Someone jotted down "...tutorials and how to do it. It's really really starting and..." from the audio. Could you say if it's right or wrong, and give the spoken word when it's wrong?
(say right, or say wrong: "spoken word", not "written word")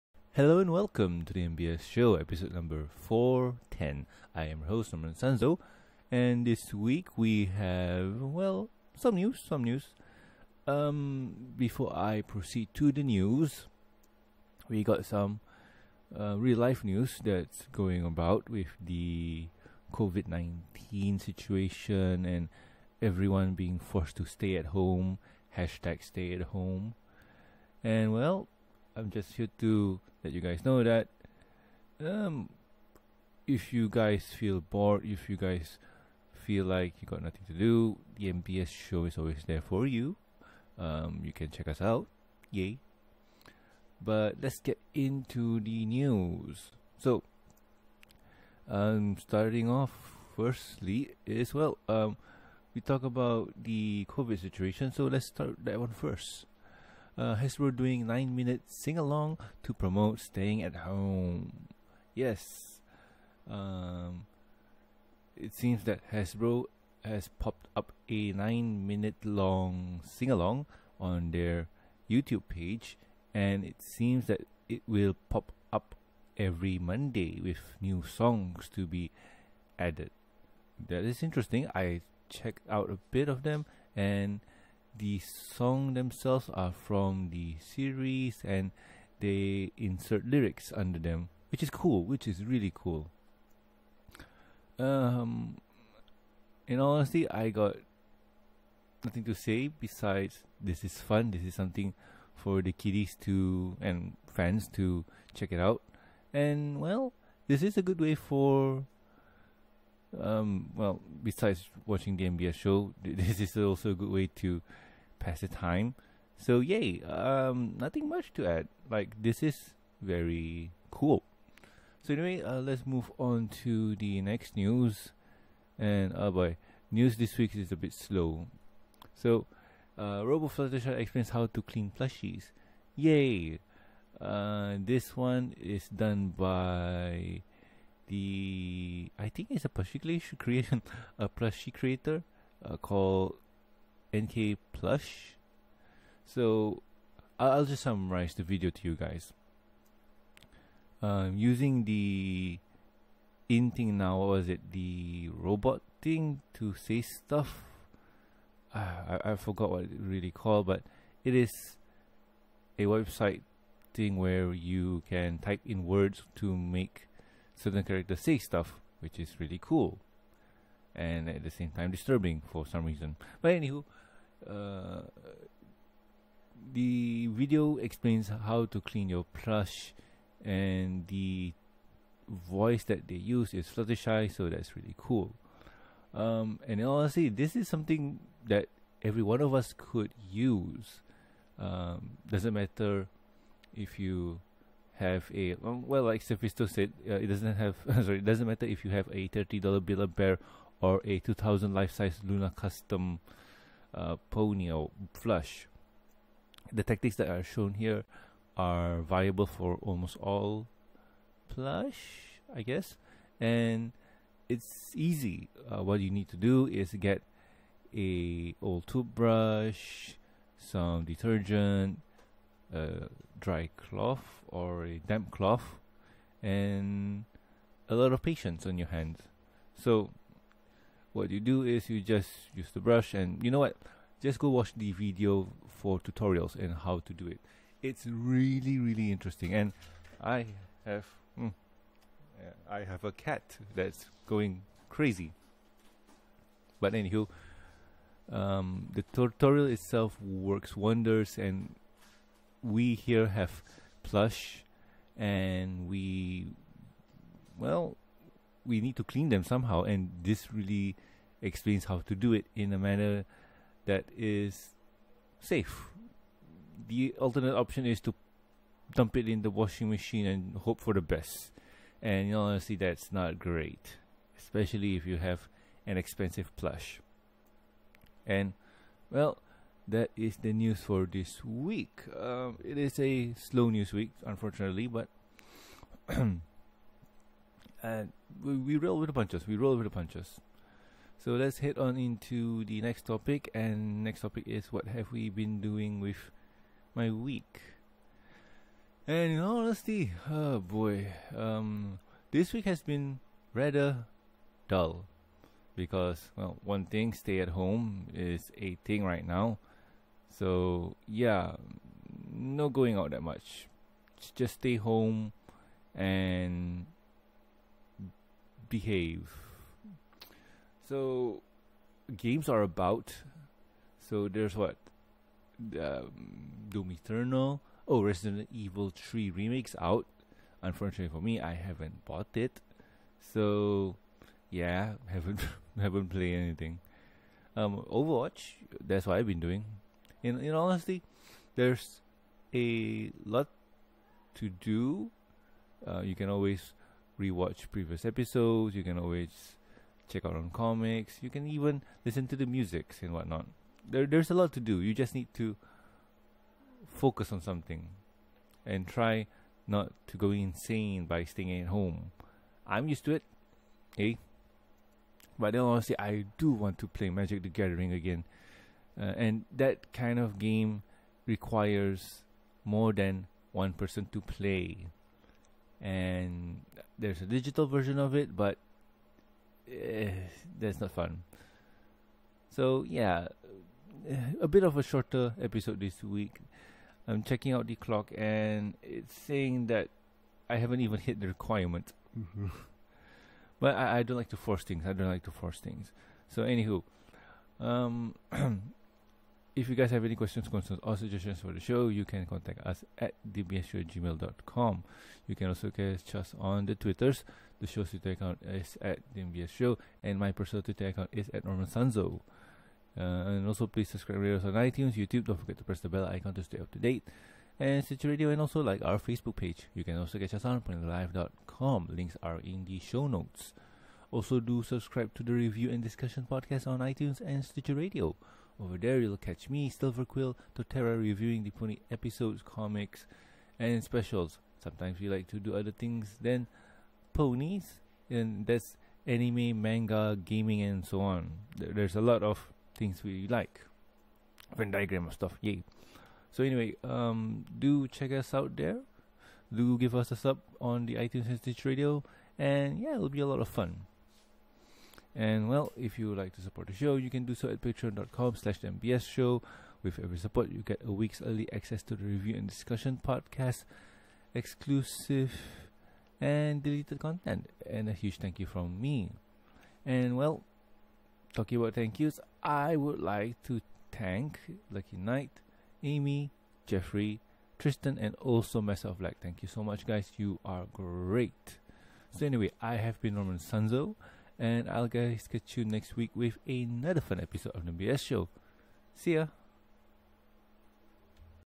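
wrong: "interesting", not "starting".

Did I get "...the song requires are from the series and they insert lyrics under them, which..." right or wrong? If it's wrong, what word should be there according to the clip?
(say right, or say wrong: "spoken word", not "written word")
wrong: "themselves", not "requires".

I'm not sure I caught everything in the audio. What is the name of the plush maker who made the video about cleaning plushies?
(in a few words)
NK Plush.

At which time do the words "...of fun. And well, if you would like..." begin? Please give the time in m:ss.
7:33.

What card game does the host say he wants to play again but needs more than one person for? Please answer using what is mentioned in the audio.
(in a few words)
Magic the Gathering.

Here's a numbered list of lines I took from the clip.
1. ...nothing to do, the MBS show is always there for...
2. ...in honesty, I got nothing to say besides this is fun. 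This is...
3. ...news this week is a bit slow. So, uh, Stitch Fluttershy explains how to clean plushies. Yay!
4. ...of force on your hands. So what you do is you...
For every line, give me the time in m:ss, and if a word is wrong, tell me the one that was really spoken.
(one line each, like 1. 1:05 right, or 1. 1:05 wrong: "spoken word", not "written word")
1. 0:37 right
2. 1:36 right
3. 2:06 wrong: "Robo", not "Stitch"
4. 3:48 wrong: "patience", not "force".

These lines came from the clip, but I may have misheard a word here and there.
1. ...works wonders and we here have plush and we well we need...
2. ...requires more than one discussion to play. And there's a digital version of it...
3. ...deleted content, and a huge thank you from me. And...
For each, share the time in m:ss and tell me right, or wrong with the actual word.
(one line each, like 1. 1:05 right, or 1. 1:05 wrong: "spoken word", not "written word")
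1. 4:10 right
2. 6:11 wrong: "person", not "discussion"
3. 7:46 right.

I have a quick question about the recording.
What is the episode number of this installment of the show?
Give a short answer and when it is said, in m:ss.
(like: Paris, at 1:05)
410, at 0:02.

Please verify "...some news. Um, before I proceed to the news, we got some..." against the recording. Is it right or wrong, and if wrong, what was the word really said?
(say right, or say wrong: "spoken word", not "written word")
right.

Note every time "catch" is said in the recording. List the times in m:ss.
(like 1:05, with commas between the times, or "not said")
6:45, 7:00, 7:09, 8:05.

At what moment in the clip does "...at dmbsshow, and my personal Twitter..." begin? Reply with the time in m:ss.
6:48.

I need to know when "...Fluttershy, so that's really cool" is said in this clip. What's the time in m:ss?
3:03.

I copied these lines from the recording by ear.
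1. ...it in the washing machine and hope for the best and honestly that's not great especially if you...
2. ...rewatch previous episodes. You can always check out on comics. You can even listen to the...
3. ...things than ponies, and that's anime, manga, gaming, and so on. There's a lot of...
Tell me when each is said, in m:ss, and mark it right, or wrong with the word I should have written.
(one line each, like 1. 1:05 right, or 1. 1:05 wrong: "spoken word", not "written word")
1. 4:29 right
2. 5:47 right
3. 7:15 right.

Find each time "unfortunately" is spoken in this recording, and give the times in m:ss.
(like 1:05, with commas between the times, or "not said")
4:44, 5:30.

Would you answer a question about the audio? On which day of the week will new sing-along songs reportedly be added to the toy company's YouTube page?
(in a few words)
Monday.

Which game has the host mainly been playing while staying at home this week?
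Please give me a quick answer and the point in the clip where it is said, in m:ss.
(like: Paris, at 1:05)
Overwatch, at 5:37.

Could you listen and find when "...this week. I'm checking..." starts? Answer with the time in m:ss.
6:25.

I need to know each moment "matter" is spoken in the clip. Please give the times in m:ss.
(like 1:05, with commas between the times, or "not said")
3:12, 3:18.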